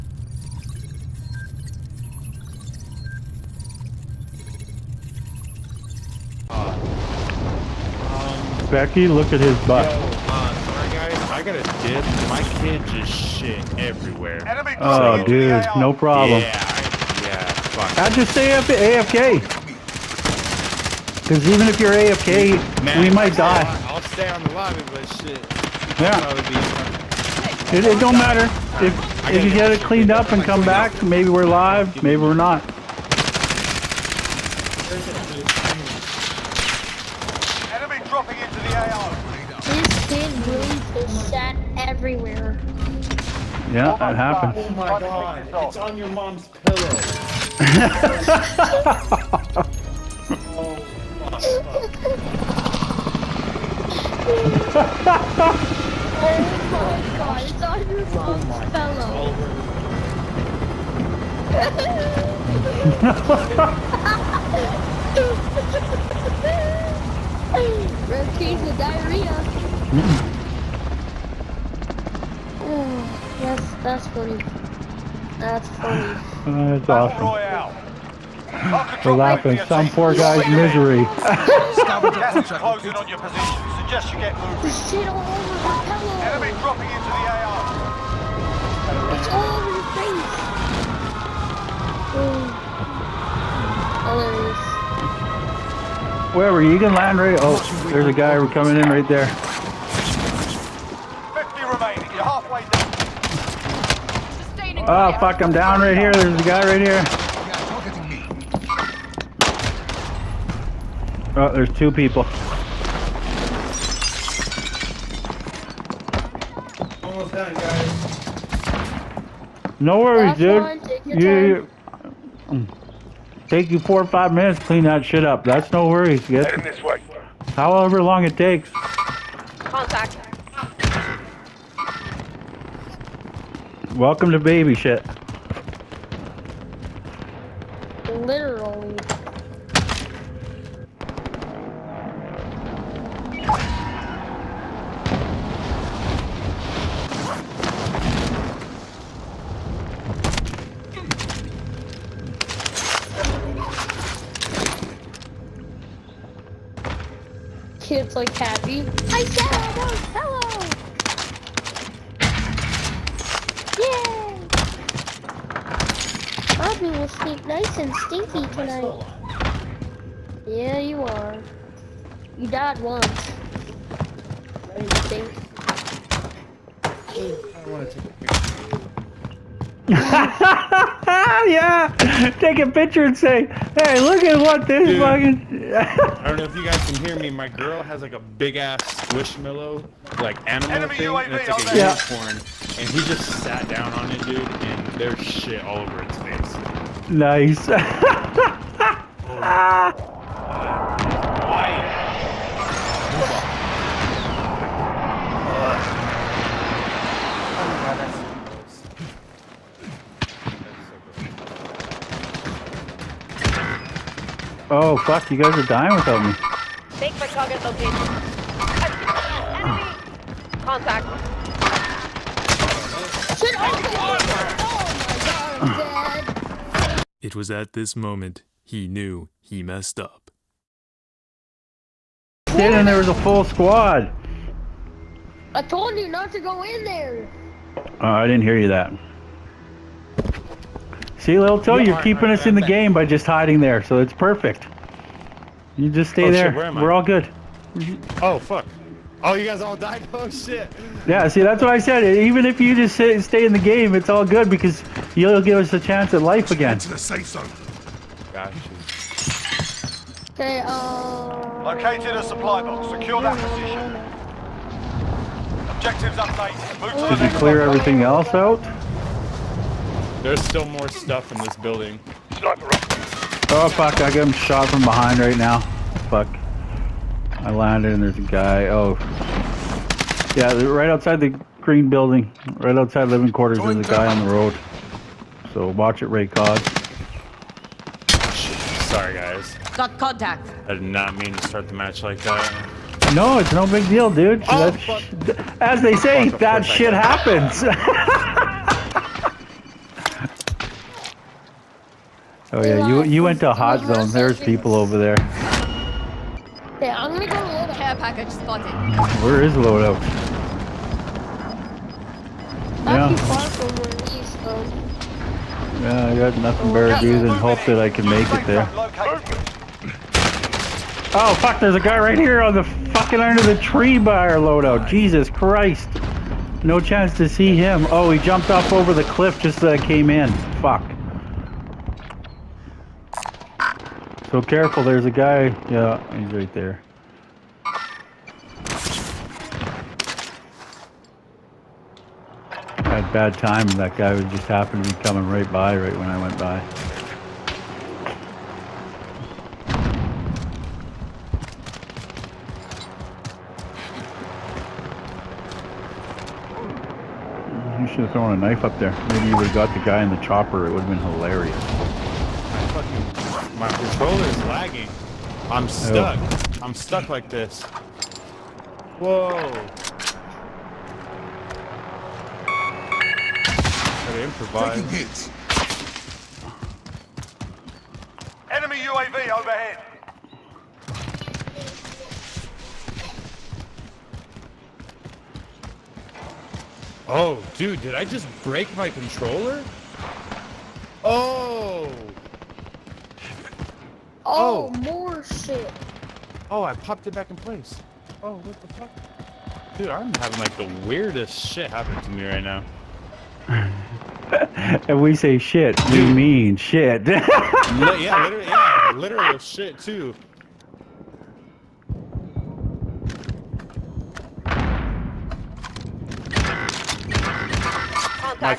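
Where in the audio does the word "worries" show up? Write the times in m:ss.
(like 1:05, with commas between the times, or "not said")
1:59, 2:05.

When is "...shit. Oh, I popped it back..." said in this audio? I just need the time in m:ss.
6:35.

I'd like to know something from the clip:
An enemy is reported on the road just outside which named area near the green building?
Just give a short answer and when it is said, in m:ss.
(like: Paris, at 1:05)
living quarters, at 4:43.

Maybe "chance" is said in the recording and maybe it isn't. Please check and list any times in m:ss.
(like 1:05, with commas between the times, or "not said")
4:15, 5:26.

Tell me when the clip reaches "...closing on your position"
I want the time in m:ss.
1:22.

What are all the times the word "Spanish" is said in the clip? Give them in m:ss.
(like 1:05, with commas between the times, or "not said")
not said.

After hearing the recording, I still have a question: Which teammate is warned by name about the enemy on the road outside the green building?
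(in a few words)
Ray Cod.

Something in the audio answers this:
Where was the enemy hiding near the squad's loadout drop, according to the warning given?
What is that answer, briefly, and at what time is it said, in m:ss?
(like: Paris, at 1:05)
under the tree, at 5:23.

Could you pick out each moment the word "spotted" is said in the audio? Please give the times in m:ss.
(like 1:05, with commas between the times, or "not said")
5:08.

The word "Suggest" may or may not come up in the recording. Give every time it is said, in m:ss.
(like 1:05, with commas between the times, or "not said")
1:23.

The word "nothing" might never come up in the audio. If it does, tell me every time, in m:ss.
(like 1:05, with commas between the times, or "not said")
5:16.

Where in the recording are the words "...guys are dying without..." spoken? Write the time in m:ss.
3:35.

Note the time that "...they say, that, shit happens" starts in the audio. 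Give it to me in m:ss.
4:55.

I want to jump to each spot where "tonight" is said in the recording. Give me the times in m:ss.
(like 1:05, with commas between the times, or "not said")
2:48.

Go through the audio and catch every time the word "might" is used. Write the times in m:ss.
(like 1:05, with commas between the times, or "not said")
0:23.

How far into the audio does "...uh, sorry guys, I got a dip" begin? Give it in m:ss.
0:10.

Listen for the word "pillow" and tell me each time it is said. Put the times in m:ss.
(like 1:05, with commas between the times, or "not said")
0:46, 1:07.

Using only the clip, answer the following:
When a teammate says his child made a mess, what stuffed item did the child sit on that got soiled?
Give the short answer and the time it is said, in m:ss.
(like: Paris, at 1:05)
squishmallow, at 3:08.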